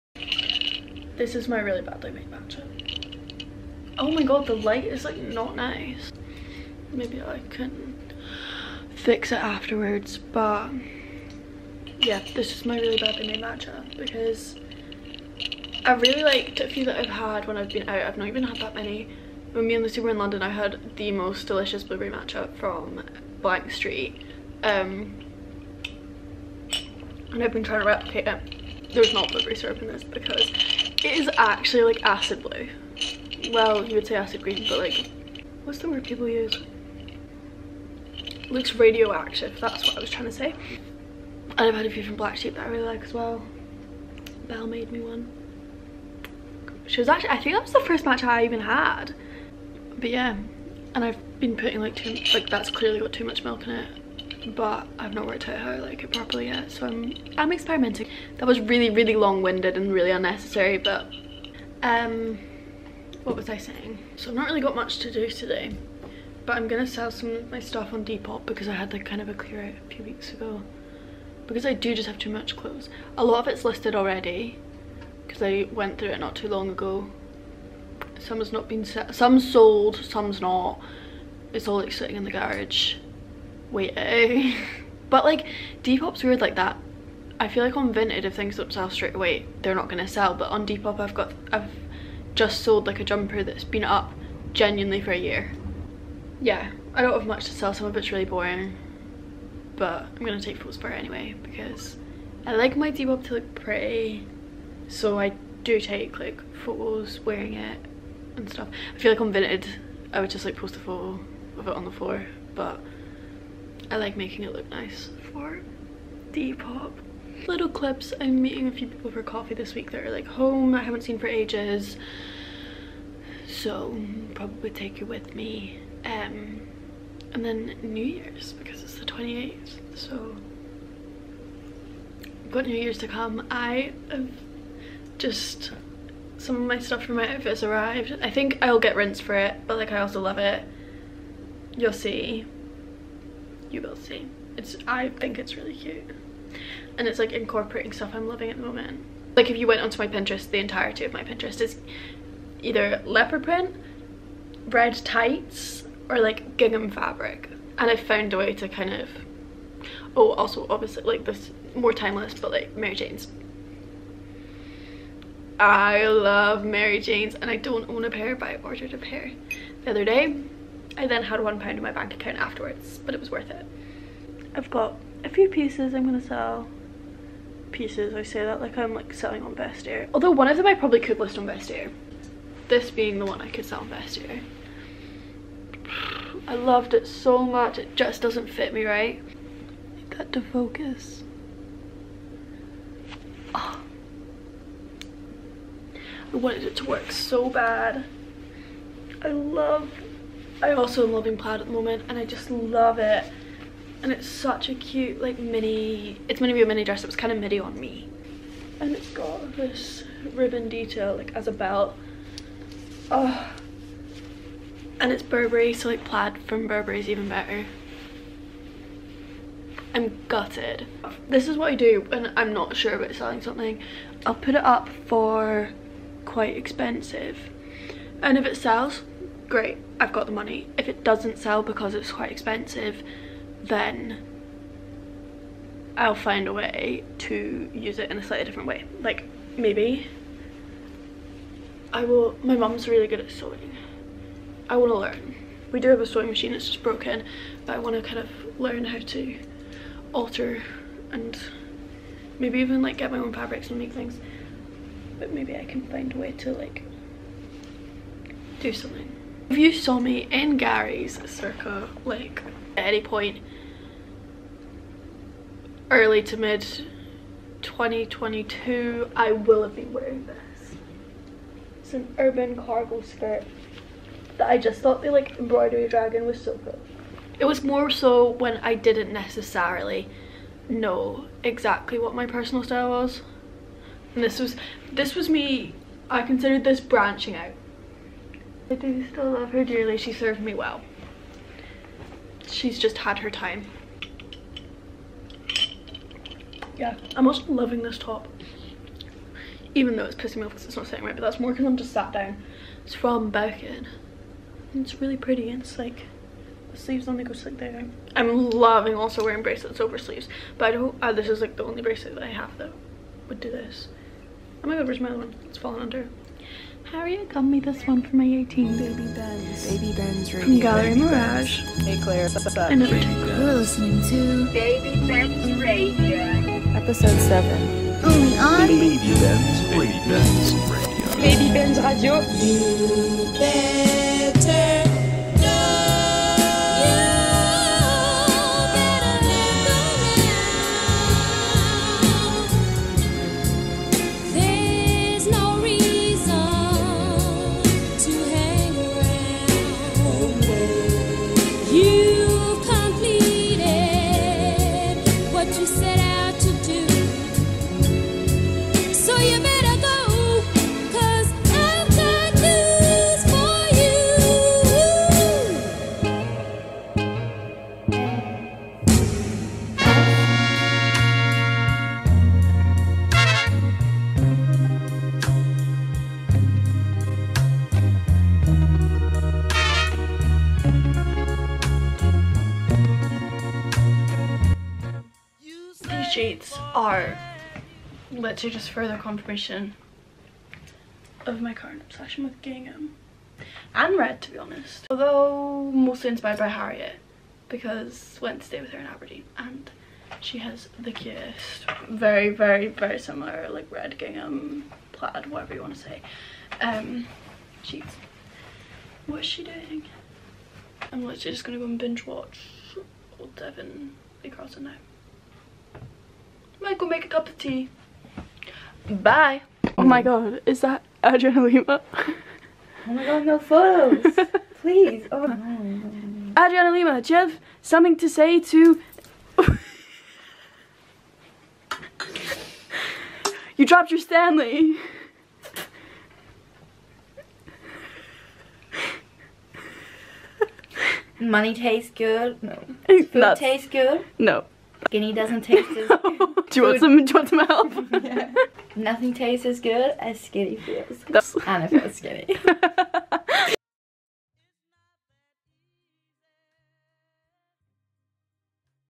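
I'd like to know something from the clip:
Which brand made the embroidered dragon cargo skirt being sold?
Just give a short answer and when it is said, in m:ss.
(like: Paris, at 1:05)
Urban, at 4:32.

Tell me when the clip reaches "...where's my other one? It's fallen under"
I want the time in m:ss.
5:14.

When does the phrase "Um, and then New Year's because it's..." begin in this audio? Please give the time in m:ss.
2:06.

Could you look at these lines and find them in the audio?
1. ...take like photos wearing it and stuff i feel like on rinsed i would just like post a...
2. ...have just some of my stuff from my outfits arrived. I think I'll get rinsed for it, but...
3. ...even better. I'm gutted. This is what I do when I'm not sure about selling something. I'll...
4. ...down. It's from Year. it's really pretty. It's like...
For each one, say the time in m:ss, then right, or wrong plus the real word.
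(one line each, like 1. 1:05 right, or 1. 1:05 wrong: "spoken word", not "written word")
1. 1:45 wrong: "vinted", not "rinsed"
2. 2:14 right
3. 3:37 right
4. 5:02 wrong: "Birkin", not "Year".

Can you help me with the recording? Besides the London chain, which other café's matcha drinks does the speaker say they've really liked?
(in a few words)
Black Sheep.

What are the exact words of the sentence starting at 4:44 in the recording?
And this was this was me I considered this branching out I do still love her dearly.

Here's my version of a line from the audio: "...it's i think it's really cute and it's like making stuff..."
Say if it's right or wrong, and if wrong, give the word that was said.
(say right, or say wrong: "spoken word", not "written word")
wrong: "incorporating", not "making".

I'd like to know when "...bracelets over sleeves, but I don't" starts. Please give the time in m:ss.
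5:09.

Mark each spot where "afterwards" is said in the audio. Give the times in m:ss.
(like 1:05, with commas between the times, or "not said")
0:09, 2:52.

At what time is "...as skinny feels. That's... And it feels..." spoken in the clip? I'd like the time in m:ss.
7:29.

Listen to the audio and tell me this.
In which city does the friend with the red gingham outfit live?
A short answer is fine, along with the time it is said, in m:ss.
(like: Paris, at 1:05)
Aberdeen, at 6:38.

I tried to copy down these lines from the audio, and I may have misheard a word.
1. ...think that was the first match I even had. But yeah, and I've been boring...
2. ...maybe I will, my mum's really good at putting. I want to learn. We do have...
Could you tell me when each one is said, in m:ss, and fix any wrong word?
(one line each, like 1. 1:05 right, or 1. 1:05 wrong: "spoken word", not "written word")
1. 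0:47 wrong: "putting", not "boring"
2. 3:59 wrong: "sewing", not "putting".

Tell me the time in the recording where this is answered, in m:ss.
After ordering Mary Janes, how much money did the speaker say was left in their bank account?
2:51.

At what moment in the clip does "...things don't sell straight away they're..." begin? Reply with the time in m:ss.
1:28.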